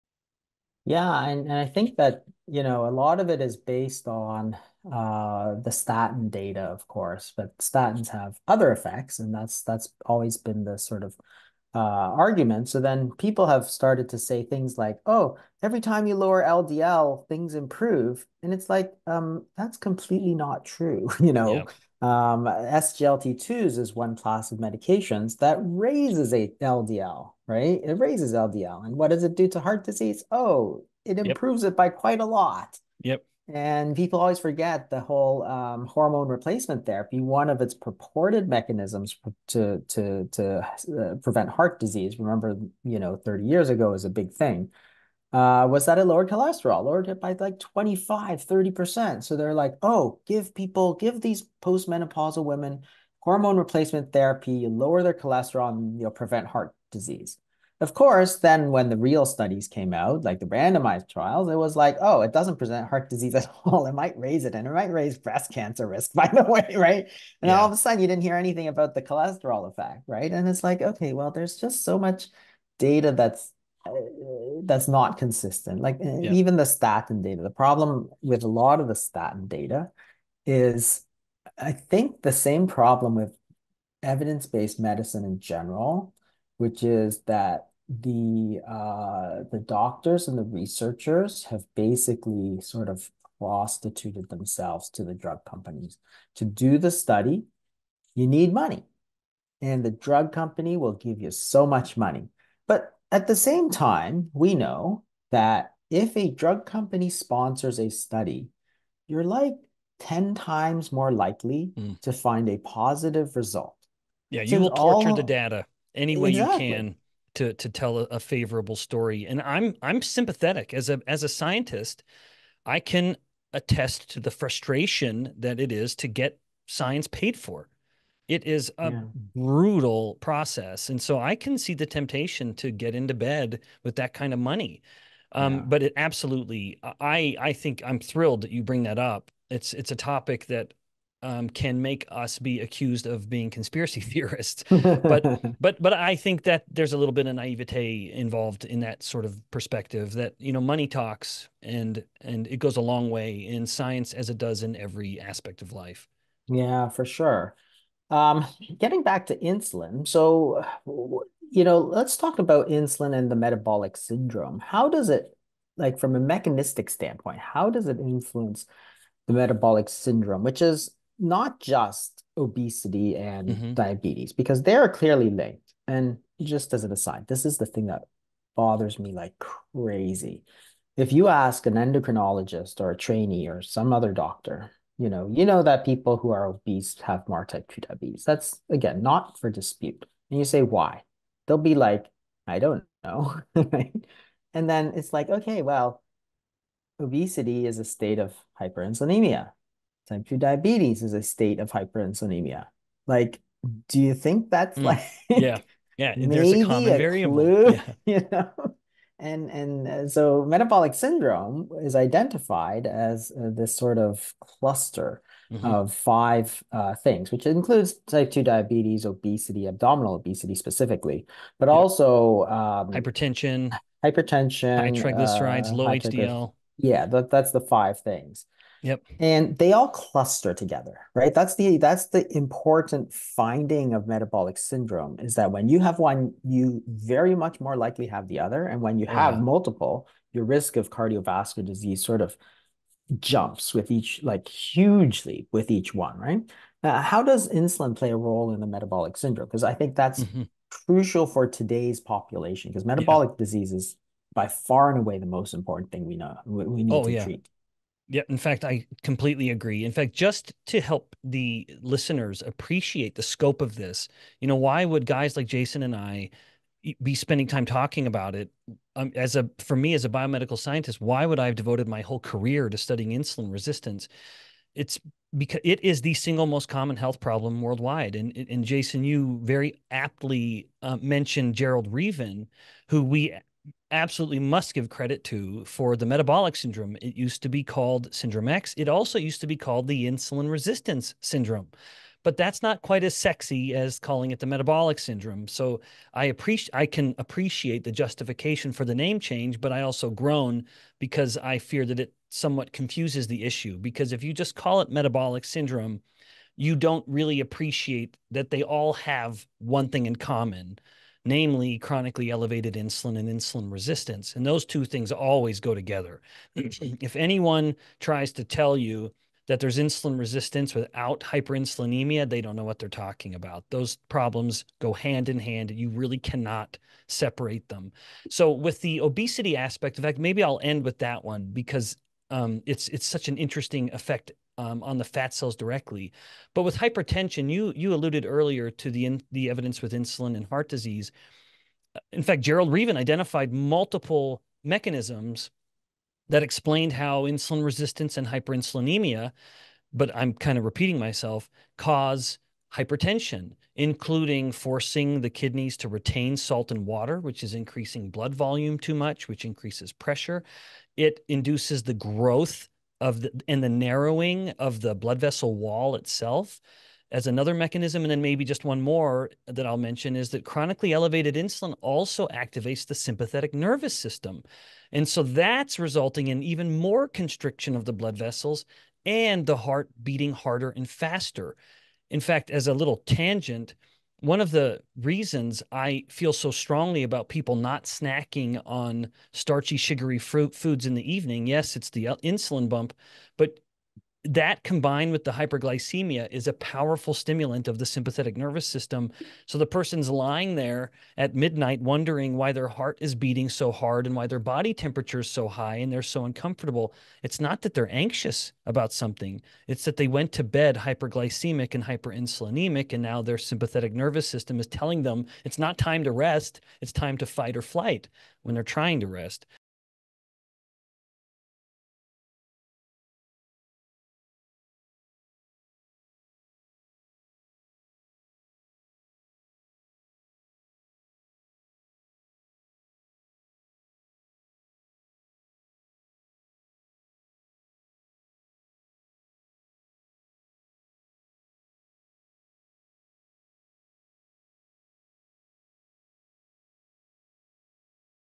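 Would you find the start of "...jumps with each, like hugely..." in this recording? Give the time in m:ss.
4:03.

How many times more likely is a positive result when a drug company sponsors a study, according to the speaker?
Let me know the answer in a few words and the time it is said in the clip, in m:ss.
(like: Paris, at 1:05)
10 times, at 1:49.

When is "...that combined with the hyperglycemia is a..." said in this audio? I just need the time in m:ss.
6:34.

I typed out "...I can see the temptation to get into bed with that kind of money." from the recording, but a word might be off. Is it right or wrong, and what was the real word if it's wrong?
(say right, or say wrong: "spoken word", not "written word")
right.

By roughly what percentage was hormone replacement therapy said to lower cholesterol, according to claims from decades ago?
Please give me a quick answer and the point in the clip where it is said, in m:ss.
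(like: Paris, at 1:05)
25-30%, at 0:47.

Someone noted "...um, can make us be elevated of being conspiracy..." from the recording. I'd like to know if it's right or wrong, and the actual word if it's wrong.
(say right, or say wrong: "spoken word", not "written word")
wrong: "accused", not "elevated".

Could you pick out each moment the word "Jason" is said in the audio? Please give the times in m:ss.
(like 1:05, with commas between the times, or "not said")
4:25, 4:38.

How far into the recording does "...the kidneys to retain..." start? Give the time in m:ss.
5:55.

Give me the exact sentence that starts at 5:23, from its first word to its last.
Those problems go hand in hand.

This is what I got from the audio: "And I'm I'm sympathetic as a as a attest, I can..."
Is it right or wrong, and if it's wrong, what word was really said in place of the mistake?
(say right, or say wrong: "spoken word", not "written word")
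wrong: "scientist", not "attest".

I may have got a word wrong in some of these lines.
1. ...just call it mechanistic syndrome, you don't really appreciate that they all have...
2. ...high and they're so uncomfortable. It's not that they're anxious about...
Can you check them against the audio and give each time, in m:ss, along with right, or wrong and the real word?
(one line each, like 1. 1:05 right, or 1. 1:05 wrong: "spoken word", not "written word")
1. 5:04 wrong: "metabolic", not "mechanistic"
2. 6:45 right.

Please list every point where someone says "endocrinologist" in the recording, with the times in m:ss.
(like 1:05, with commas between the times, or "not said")
3:01.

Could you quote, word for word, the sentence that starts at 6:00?
It induces the growth of the and the narrowing of the blood vessel wall itself as another mechanism.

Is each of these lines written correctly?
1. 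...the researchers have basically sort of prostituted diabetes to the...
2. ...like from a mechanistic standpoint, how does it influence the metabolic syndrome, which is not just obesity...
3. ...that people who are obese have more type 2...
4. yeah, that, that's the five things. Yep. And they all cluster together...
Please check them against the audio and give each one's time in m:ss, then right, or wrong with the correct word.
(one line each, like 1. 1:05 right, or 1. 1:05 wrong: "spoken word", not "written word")
1. 1:30 wrong: "themselves", not "diabetes"
2. 2:45 right
3. 3:05 right
4. 3:46 right.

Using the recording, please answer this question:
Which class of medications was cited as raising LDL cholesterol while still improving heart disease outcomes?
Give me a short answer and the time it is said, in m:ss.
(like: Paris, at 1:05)
SGLT2s, at 0:22.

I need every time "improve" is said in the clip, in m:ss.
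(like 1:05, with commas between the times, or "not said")
0:17, 0:31.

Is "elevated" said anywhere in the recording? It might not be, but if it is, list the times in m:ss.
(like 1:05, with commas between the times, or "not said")
5:12, 6:10.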